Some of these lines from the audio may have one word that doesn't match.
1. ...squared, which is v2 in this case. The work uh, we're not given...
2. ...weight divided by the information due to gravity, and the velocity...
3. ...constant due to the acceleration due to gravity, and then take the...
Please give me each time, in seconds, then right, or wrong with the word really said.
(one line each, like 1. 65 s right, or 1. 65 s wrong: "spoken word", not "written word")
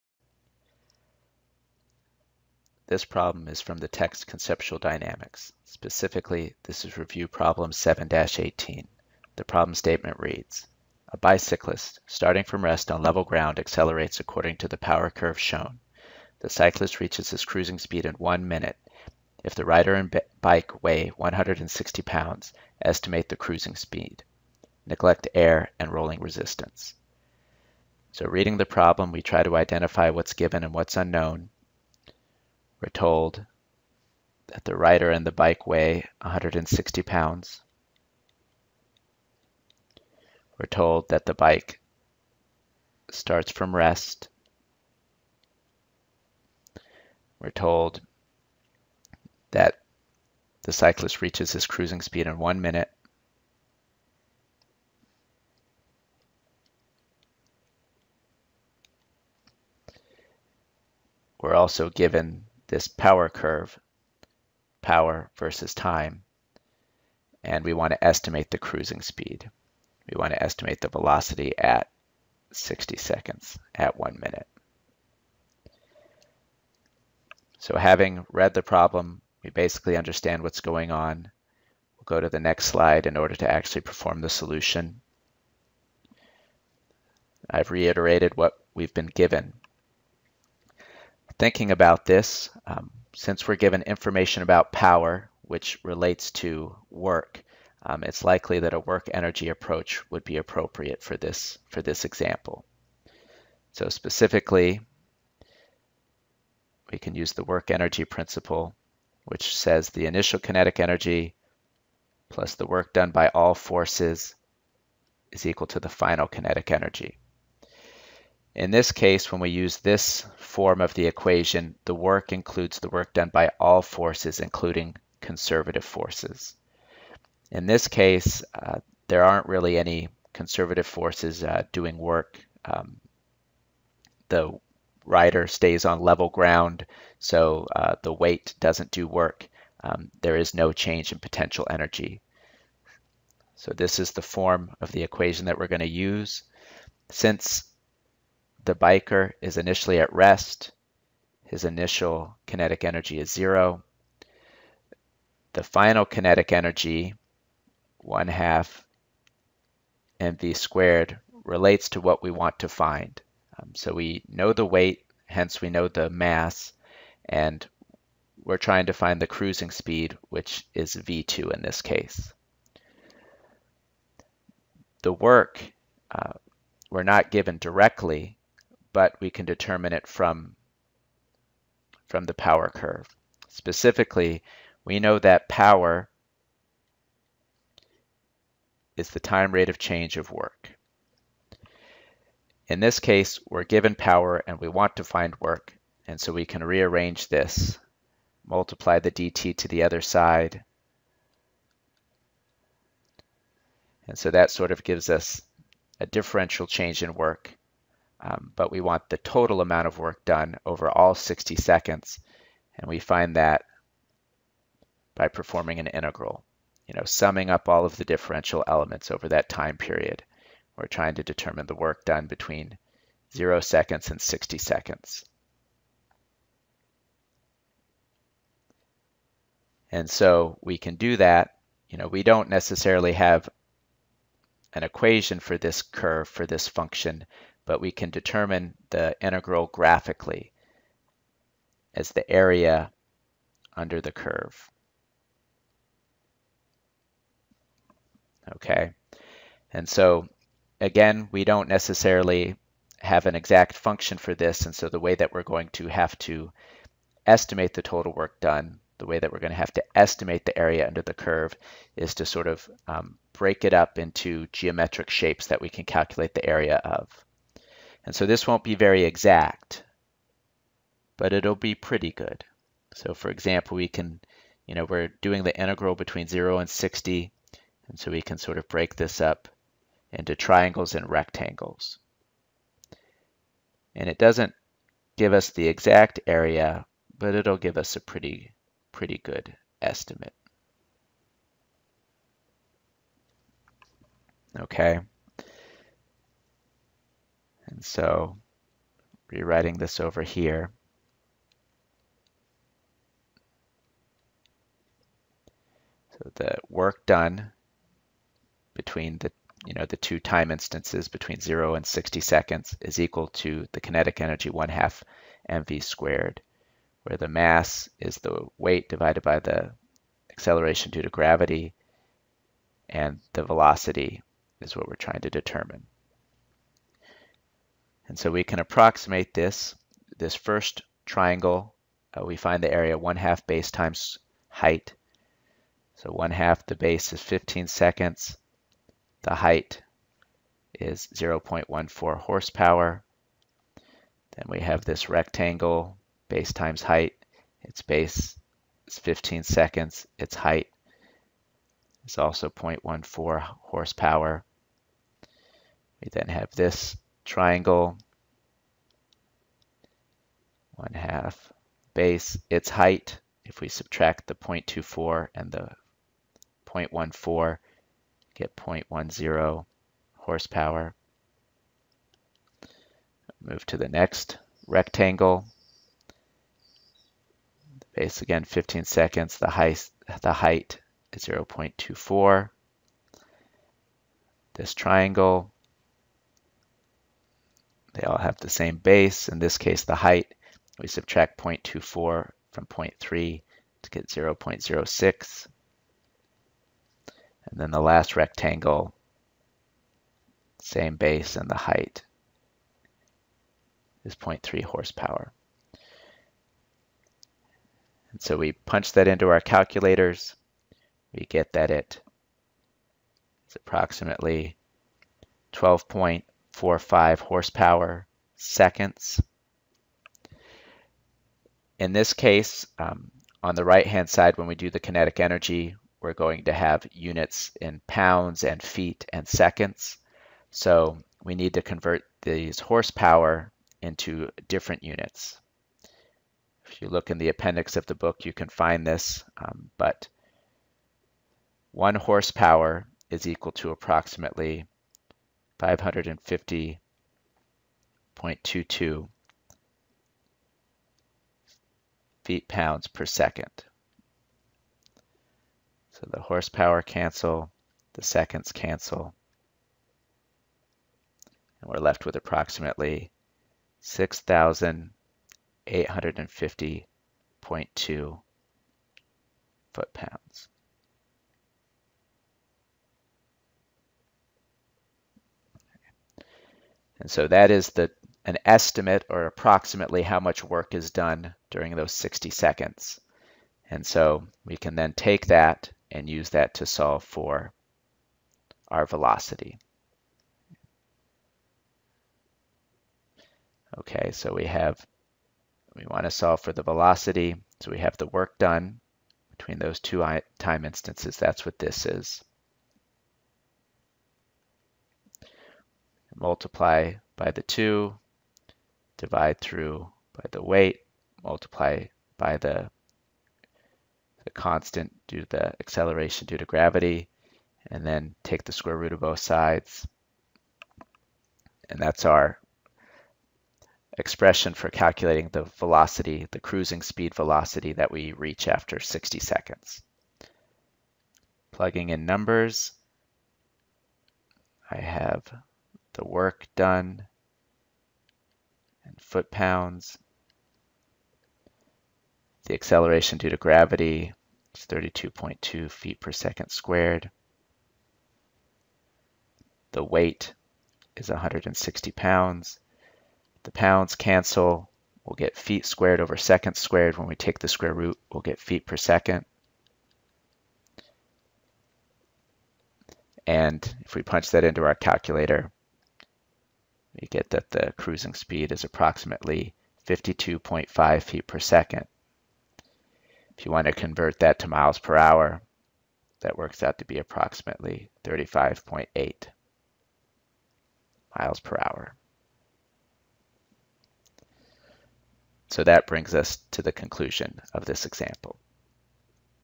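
1. 169 s wrong: "speed", not "squared"
2. 318 s wrong: "acceleration", not "information"
3. 514 s right.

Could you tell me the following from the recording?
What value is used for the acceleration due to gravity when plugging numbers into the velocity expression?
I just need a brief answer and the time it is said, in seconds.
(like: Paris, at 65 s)
32.2 feet per second squared, at 544 s.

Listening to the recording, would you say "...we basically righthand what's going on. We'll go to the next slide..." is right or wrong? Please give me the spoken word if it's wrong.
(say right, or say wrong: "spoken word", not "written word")
wrong: "understand", not "righthand".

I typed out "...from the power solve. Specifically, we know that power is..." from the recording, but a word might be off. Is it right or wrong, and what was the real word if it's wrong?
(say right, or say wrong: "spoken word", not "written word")
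wrong: "curve", not "solve".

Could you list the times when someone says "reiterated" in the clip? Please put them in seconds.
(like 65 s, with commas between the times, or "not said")
87 s.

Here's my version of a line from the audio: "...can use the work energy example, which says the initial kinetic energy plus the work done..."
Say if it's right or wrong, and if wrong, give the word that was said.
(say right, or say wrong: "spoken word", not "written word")
wrong: "principle", not "example".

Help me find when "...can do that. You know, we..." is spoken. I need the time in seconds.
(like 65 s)
230 s.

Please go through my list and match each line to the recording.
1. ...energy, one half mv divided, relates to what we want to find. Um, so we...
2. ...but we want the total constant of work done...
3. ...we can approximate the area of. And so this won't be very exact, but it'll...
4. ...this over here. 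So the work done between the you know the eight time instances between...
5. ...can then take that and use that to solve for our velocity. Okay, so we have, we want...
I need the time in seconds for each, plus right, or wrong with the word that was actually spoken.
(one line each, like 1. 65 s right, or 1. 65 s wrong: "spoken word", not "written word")
1. 156 s wrong: "squared", not "divided"
2. 208 s wrong: "amount", not "constant"
3. 265 s wrong: "calculate", not "approximate"
4. 299 s wrong: "two", not "eight"
5. 484 s right.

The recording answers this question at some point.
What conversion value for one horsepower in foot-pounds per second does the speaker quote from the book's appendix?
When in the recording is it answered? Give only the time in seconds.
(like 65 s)
445 s.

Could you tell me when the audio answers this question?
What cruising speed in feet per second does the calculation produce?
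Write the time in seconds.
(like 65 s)
569 s.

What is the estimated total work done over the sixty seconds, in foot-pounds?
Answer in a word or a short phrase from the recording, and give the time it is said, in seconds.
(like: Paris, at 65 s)
6,850.2 foot pounds, at 463 s.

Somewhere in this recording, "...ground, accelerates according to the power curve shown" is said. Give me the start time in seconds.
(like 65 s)
13 s.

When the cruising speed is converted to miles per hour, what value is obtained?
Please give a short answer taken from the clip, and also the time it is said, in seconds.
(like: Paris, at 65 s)
35.8 miles per hour, at 578 s.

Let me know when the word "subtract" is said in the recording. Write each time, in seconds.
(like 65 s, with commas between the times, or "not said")
363 s, 390 s.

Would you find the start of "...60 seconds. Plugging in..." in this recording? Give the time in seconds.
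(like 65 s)
528 s.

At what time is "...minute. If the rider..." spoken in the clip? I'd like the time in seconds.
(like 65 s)
18 s.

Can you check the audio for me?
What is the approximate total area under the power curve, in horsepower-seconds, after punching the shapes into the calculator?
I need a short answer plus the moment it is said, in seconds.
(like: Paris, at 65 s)
12.45 horsepower seconds, at 415 s.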